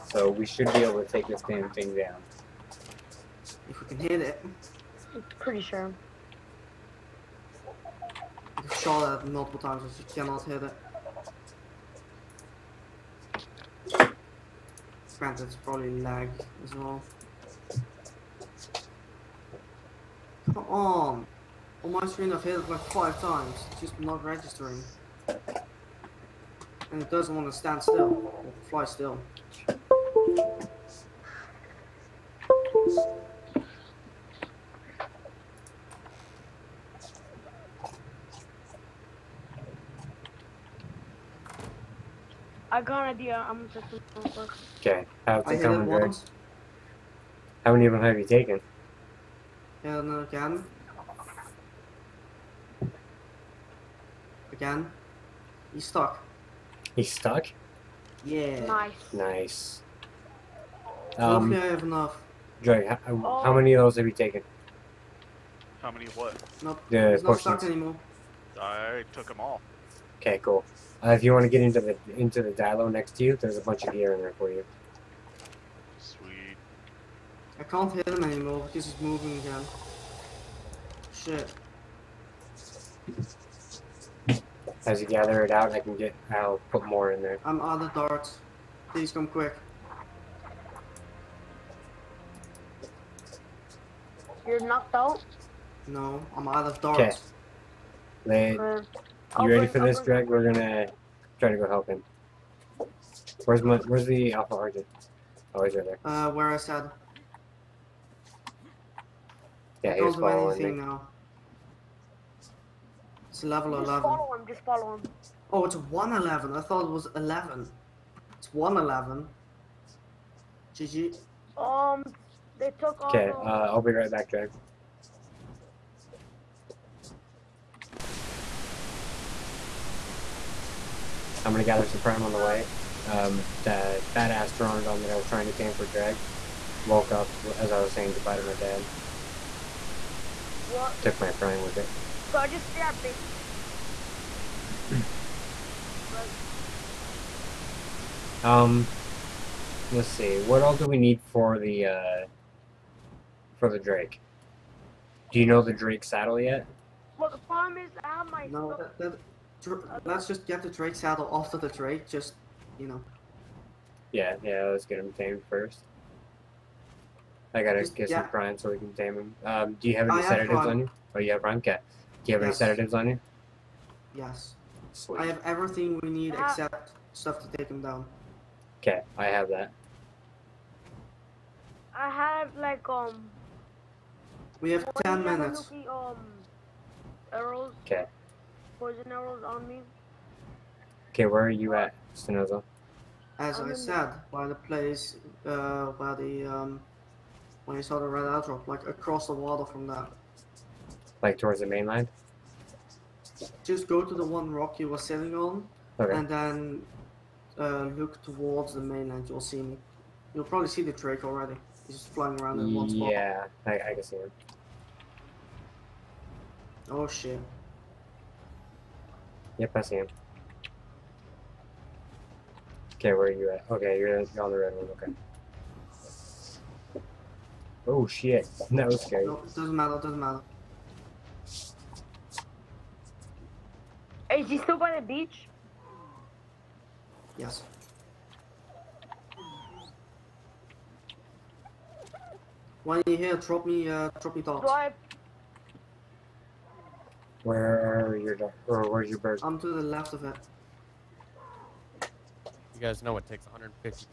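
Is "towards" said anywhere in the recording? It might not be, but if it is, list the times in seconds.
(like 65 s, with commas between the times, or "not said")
201 s, 208 s.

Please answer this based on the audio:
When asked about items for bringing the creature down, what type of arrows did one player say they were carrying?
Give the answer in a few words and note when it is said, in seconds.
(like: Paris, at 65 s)
poison arrows, at 188 s.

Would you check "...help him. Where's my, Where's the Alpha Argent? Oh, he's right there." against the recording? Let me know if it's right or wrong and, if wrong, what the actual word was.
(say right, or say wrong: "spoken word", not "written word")
right.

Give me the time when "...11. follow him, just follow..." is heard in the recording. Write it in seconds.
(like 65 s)
113 s.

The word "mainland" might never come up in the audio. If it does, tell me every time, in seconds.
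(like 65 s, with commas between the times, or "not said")
201 s, 208 s.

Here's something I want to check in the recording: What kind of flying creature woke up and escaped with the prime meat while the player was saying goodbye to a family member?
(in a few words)
Pteranodon.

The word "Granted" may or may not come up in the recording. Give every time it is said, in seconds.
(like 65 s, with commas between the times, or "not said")
15 s.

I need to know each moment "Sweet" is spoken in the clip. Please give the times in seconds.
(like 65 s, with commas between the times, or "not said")
75 s, 174 s.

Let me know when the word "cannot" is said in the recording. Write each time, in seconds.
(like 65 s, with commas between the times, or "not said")
10 s.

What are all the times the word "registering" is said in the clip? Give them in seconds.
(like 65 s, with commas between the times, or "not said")
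24 s.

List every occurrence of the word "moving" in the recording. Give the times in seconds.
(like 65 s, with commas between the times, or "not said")
79 s.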